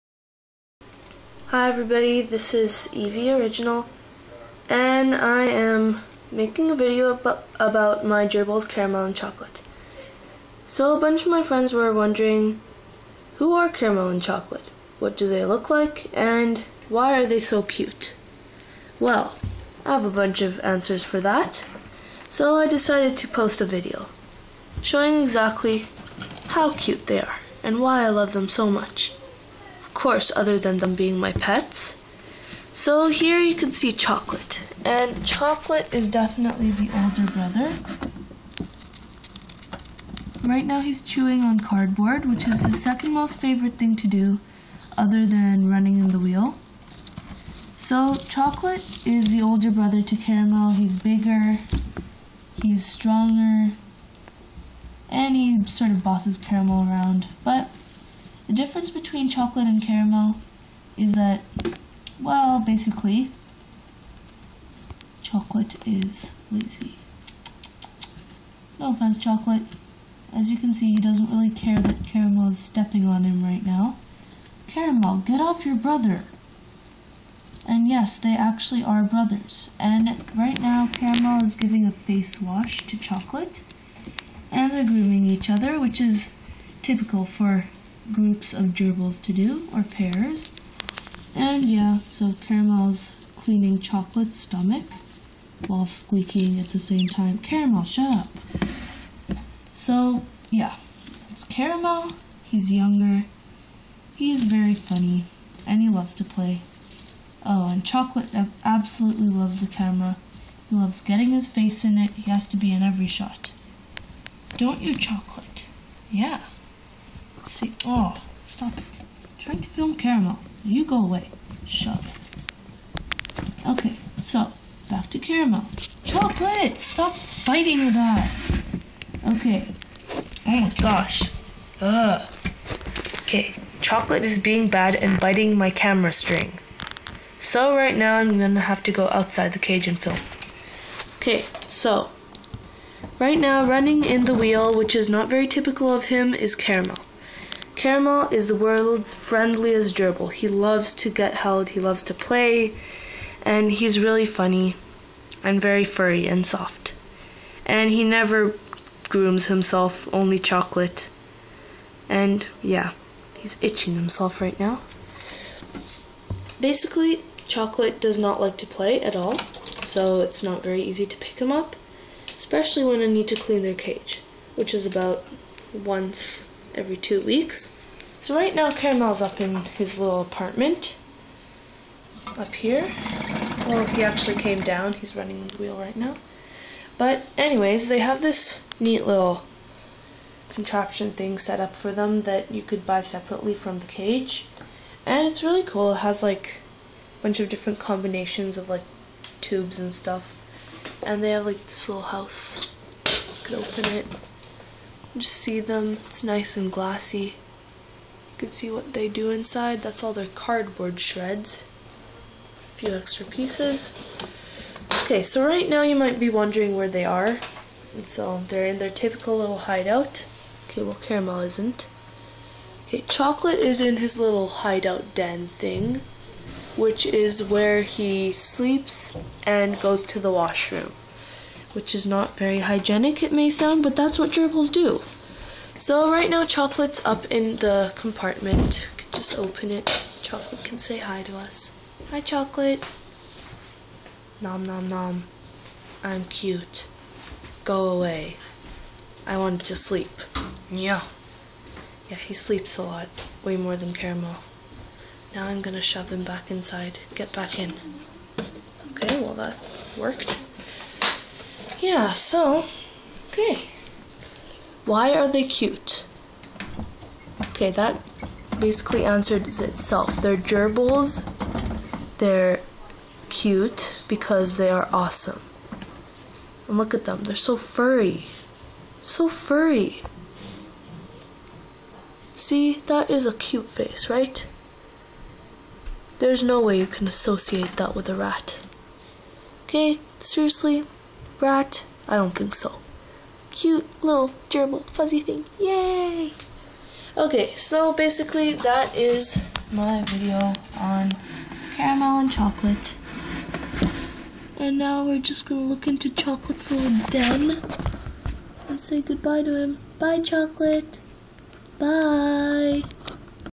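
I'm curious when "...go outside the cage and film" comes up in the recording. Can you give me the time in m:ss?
2:18.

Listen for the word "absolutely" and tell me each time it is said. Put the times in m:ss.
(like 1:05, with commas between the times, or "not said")
1:48.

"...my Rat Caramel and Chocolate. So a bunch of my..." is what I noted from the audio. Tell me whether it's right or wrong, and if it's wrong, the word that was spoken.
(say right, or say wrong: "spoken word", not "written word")
wrong: "Gerbils", not "Rat".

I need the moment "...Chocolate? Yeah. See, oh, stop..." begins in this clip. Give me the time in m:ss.
1:54.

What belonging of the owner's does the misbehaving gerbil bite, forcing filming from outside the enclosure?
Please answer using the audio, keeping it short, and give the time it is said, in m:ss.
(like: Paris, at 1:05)
Camera string, at 2:15.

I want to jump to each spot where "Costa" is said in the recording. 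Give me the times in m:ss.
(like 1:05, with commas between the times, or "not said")
not said.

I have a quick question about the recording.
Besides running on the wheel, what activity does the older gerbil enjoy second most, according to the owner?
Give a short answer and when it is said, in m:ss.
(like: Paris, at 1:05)
Chewing on cardboard, at 0:41.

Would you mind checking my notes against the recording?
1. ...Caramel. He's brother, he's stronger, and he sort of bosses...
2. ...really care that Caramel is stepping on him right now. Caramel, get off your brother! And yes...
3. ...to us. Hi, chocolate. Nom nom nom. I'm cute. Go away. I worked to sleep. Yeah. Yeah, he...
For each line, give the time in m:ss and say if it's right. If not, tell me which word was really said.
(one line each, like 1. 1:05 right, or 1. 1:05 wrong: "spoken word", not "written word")
1. 0:50 wrong: "bigger", not "brother"
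2. 1:11 right
3. 4:01 wrong: "wanted", not "worked".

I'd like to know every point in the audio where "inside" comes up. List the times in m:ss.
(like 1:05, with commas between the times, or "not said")
3:29, 4:16.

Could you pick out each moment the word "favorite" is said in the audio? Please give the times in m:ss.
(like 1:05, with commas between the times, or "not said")
0:43.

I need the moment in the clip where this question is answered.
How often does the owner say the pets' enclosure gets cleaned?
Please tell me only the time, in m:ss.
2:55.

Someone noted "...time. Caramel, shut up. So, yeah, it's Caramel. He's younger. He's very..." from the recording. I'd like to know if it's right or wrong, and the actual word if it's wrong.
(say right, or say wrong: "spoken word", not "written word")
right.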